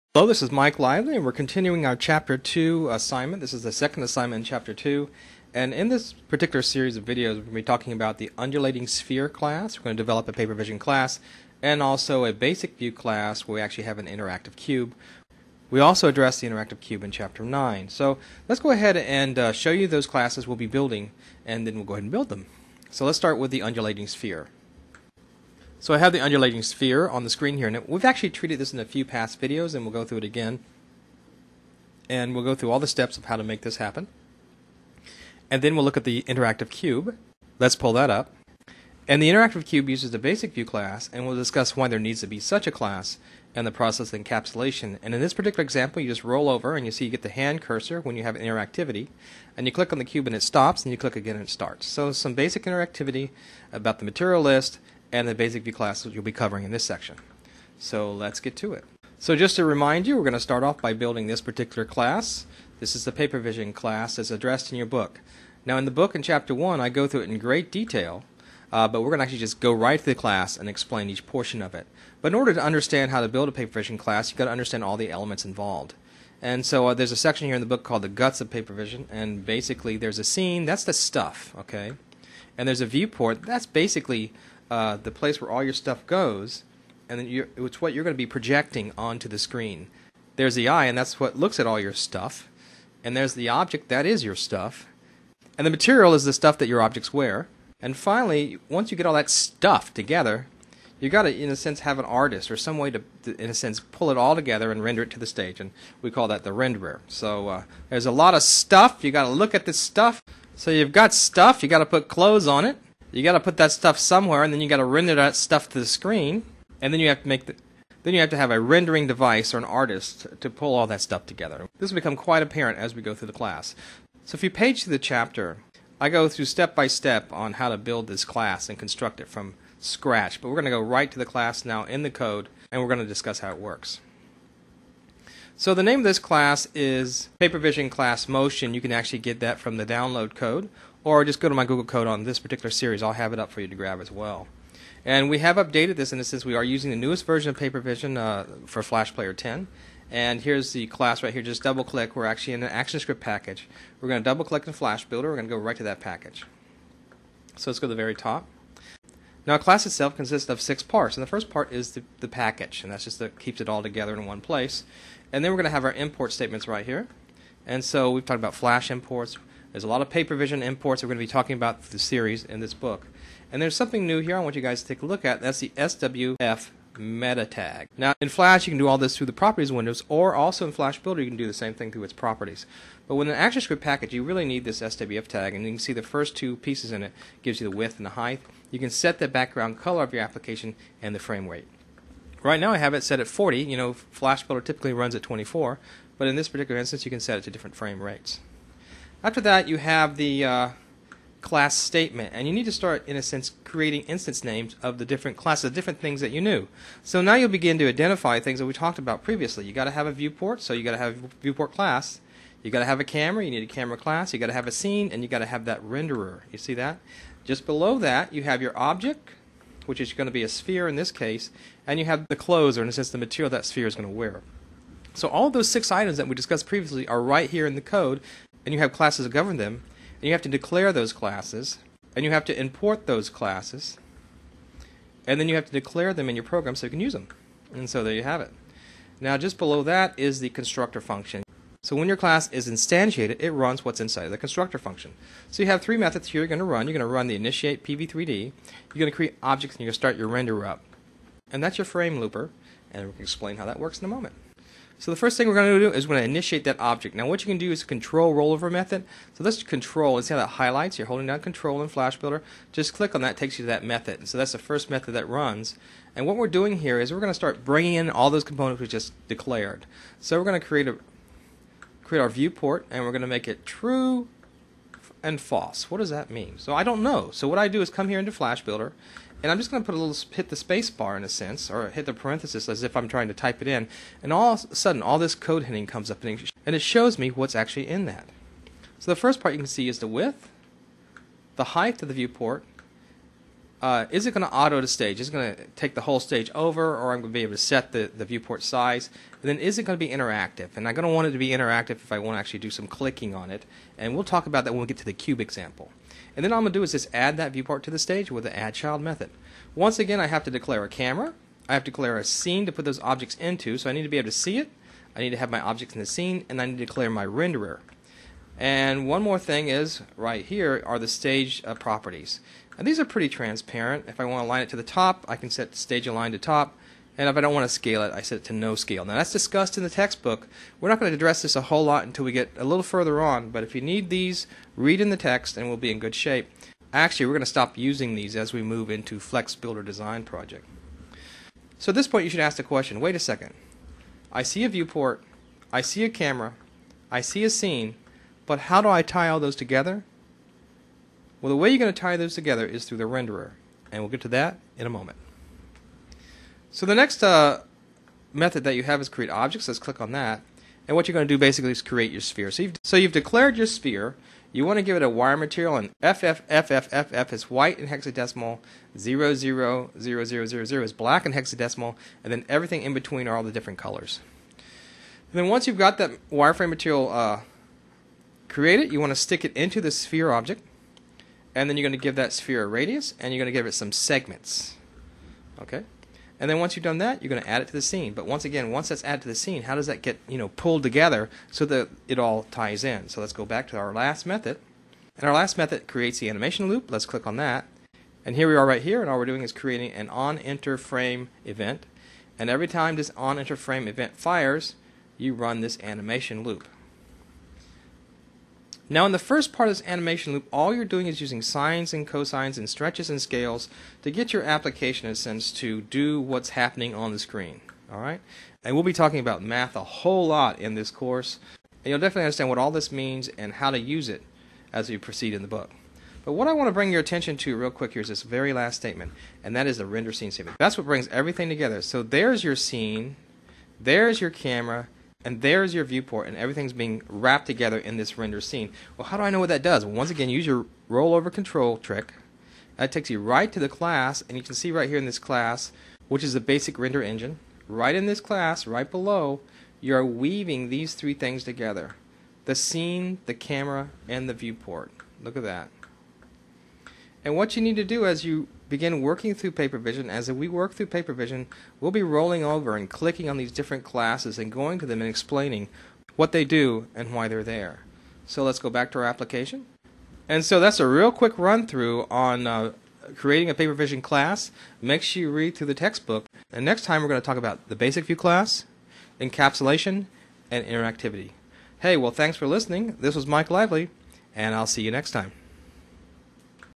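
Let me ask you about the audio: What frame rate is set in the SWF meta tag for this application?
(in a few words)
40.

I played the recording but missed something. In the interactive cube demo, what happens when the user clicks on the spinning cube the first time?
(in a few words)
It stops.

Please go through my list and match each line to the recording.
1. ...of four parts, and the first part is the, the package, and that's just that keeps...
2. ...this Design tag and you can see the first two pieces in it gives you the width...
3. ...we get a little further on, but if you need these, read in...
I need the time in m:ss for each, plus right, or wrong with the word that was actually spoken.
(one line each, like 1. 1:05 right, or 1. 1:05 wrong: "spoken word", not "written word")
1. 2:40 wrong: "six", not "four"
2. 3:04 wrong: "SWF", not "Design"
3. 5:32 right.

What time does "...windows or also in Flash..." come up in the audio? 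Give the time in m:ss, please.
2:59.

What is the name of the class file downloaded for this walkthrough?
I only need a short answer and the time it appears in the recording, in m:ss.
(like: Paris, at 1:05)
PaperVision Class Motion, at 2:17.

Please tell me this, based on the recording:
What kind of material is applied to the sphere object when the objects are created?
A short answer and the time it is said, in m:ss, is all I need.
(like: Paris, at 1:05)
Wire material, at 6:05.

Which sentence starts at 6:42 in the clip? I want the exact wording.
And every time this on-enter frame event fires, you run this animation loop.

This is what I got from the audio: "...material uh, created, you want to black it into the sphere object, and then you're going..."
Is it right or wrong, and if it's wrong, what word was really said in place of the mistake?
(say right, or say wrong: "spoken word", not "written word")
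wrong: "stick", not "black".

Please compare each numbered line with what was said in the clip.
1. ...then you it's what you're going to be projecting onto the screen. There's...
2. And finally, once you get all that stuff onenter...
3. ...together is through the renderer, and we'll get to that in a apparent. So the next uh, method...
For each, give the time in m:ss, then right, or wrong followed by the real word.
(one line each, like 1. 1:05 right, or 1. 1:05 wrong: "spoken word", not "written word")
1. 1:27 right
2. 1:37 wrong: "together", not "onenter"
3. 5:52 wrong: "moment", not "apparent".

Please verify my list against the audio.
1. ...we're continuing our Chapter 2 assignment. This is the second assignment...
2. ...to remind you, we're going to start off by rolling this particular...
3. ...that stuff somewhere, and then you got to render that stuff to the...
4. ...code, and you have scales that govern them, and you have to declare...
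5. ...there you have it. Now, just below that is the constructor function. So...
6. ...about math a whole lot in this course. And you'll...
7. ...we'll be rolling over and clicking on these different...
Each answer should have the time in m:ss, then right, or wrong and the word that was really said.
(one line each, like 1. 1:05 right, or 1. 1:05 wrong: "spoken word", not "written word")
1. 0:01 right
2. 0:59 wrong: "building", not "rolling"
3. 1:53 right
4. 3:47 wrong: "classes", not "scales"
5. 3:58 right
6. 6:59 right
7. 7:41 right.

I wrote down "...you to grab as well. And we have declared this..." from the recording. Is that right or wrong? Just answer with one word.
wrong.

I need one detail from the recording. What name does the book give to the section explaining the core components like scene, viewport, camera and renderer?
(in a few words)
The Guts of Paper Vision.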